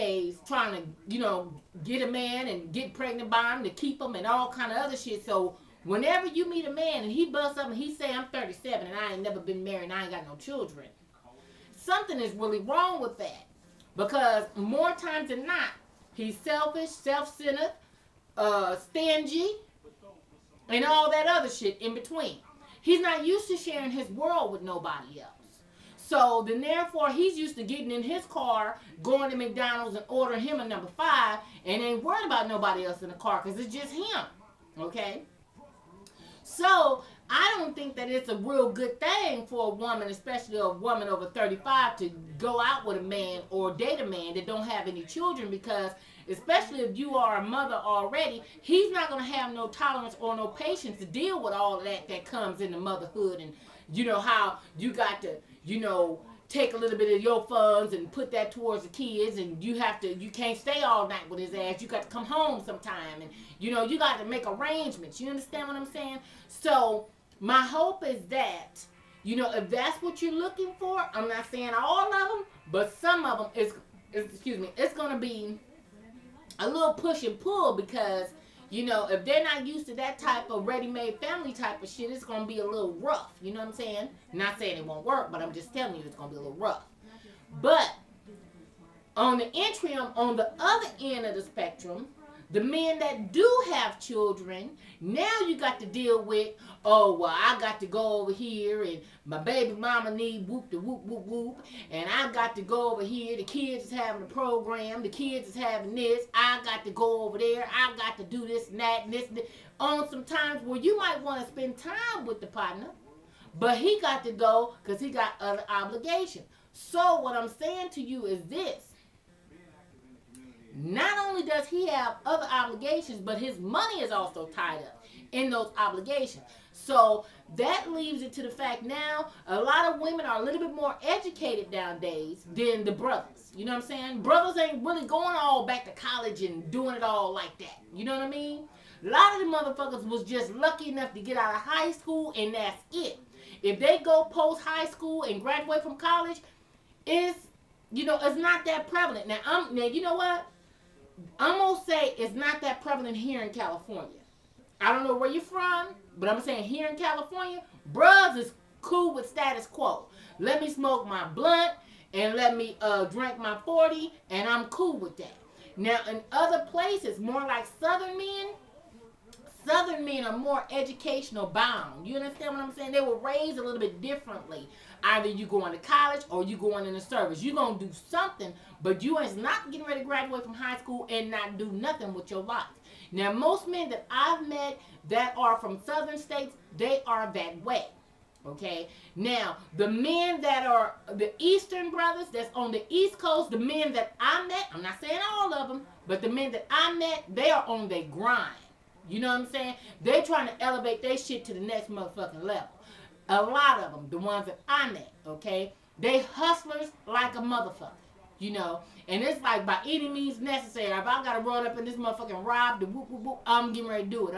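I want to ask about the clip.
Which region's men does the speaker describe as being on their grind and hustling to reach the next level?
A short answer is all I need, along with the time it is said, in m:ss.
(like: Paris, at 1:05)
East Coast, at 3:12.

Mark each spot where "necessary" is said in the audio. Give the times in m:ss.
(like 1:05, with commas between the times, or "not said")
3:30.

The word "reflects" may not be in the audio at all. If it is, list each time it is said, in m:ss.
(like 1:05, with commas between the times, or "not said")
not said.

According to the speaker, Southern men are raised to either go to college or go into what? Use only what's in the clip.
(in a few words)
the service.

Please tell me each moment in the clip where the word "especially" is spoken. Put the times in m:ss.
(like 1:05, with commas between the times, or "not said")
0:40, 0:46.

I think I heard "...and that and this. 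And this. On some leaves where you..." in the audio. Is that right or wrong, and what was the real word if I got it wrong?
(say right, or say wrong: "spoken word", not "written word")
wrong: "times", not "leaves".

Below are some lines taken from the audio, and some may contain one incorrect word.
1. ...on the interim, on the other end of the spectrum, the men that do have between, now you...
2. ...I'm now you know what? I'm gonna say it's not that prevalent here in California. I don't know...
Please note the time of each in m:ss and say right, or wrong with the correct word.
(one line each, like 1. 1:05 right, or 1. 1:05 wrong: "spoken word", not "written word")
1. 1:29 wrong: "children", not "between"
2. 2:29 right.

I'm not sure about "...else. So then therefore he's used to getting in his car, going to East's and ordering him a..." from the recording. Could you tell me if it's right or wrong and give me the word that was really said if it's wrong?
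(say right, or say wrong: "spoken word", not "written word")
wrong: "McDonald", not "East".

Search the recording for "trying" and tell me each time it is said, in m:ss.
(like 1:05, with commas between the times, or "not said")
0:00, 3:20.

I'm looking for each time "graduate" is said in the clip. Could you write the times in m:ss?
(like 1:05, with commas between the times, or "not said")
2:25, 3:00.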